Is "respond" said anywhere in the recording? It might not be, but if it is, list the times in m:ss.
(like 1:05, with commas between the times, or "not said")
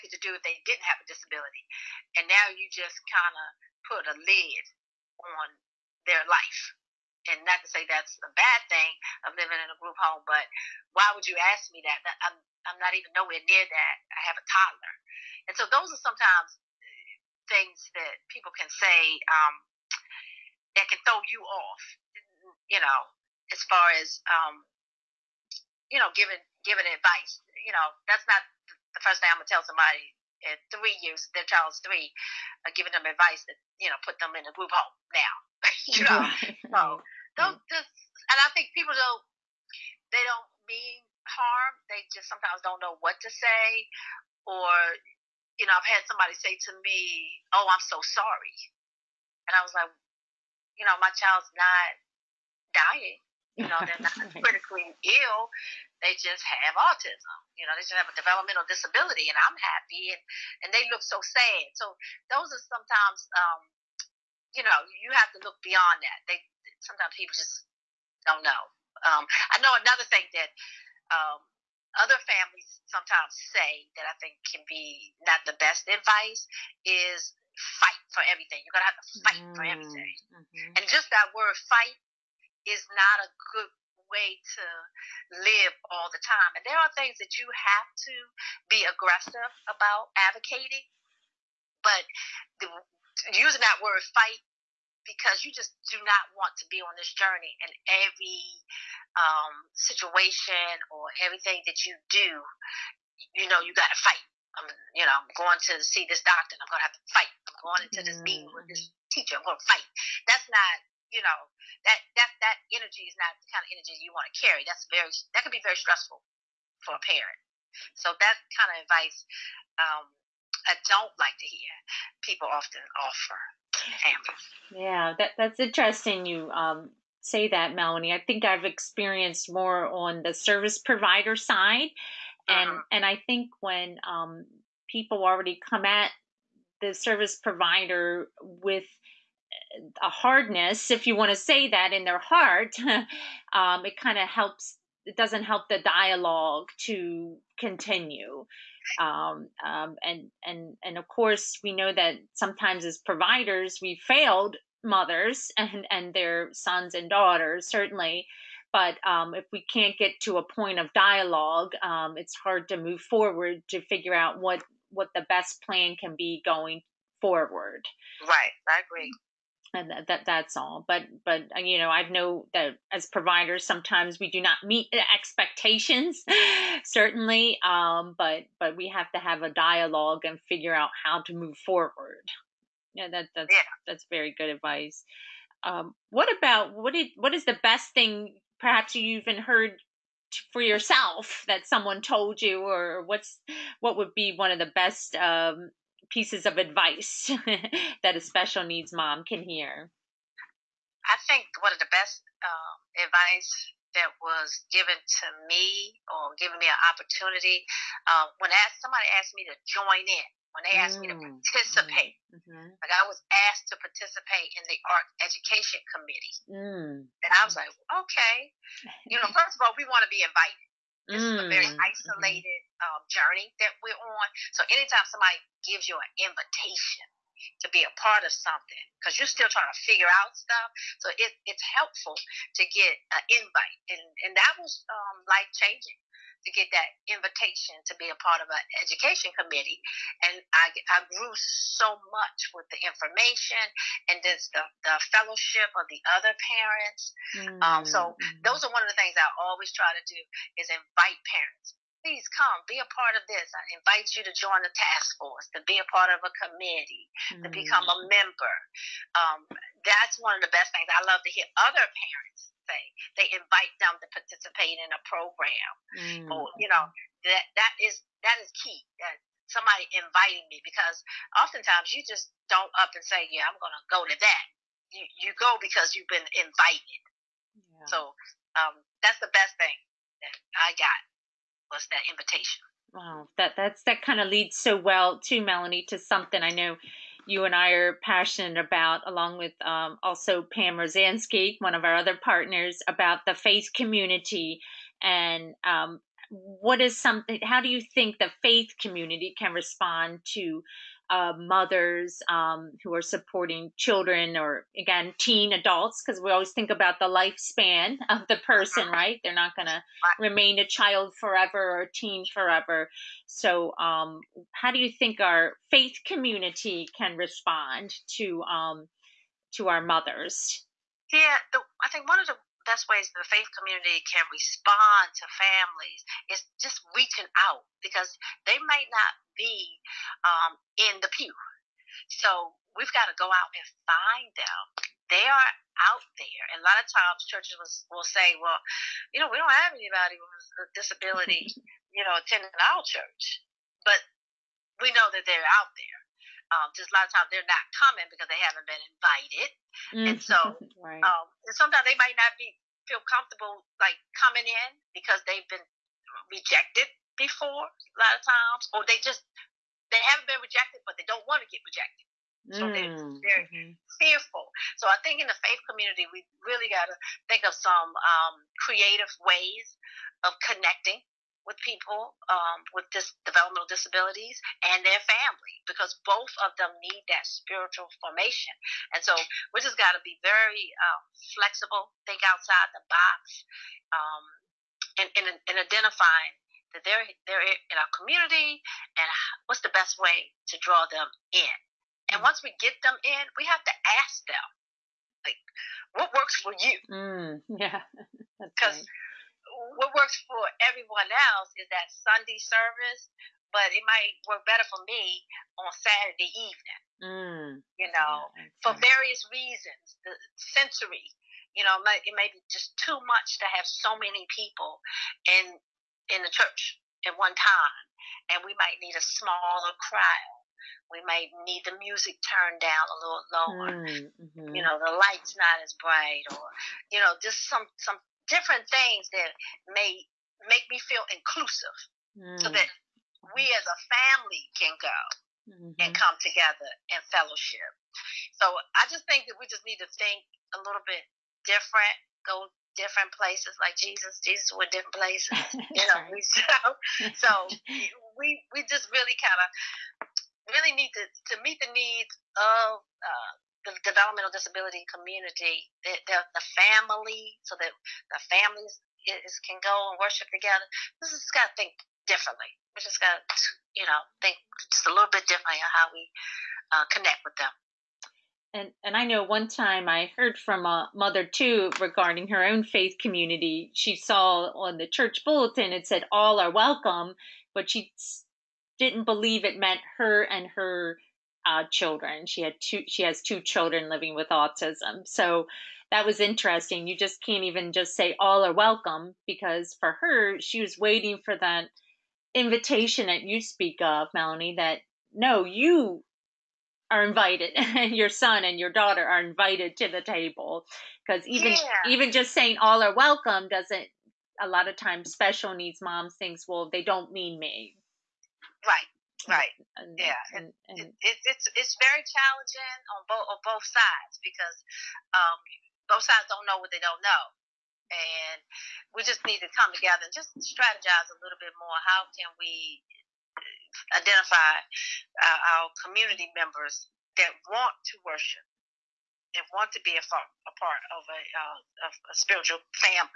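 4:59, 5:17, 5:24.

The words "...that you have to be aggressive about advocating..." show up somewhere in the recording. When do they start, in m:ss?
1:27.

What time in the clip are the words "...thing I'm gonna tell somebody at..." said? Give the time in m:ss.
0:29.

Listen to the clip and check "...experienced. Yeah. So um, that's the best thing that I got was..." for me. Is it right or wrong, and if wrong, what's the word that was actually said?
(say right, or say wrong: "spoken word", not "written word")
wrong: "invited", not "experienced".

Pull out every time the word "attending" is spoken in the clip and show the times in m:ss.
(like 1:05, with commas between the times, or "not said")
5:42.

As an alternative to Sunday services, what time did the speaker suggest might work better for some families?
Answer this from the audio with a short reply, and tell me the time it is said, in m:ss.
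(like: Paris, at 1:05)
Saturday evening, at 6:45.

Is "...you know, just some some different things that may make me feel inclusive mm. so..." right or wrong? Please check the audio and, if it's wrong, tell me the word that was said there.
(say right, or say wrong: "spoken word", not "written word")
right.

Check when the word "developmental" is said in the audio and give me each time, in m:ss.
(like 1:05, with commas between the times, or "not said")
0:58, 6:13, 7:33.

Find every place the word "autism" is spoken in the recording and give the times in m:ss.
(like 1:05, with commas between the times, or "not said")
0:56, 8:04.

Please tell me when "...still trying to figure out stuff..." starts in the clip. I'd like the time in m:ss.
3:49.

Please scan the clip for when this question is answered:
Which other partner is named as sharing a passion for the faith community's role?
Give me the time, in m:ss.
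4:50.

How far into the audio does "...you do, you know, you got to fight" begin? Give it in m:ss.
1:41.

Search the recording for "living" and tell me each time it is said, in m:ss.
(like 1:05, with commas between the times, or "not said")
0:09, 8:03.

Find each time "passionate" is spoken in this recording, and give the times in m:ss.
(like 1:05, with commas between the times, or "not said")
4:48.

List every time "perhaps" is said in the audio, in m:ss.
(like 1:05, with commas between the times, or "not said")
3:08.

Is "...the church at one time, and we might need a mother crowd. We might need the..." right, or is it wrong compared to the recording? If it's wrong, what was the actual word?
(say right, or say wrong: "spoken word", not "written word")
wrong: "smaller", not "mother".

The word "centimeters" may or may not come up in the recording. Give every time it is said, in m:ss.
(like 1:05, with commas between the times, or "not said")
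not said.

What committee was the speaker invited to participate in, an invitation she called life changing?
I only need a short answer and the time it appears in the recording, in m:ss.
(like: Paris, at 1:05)
art education committee, at 3:34.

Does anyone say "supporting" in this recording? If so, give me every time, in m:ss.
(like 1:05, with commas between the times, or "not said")
5:03.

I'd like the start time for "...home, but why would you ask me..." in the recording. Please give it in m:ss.
0:10.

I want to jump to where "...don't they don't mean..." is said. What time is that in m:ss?
0:38.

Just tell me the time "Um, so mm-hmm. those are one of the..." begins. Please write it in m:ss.
4:07.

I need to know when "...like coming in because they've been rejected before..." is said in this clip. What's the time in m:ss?
5:53.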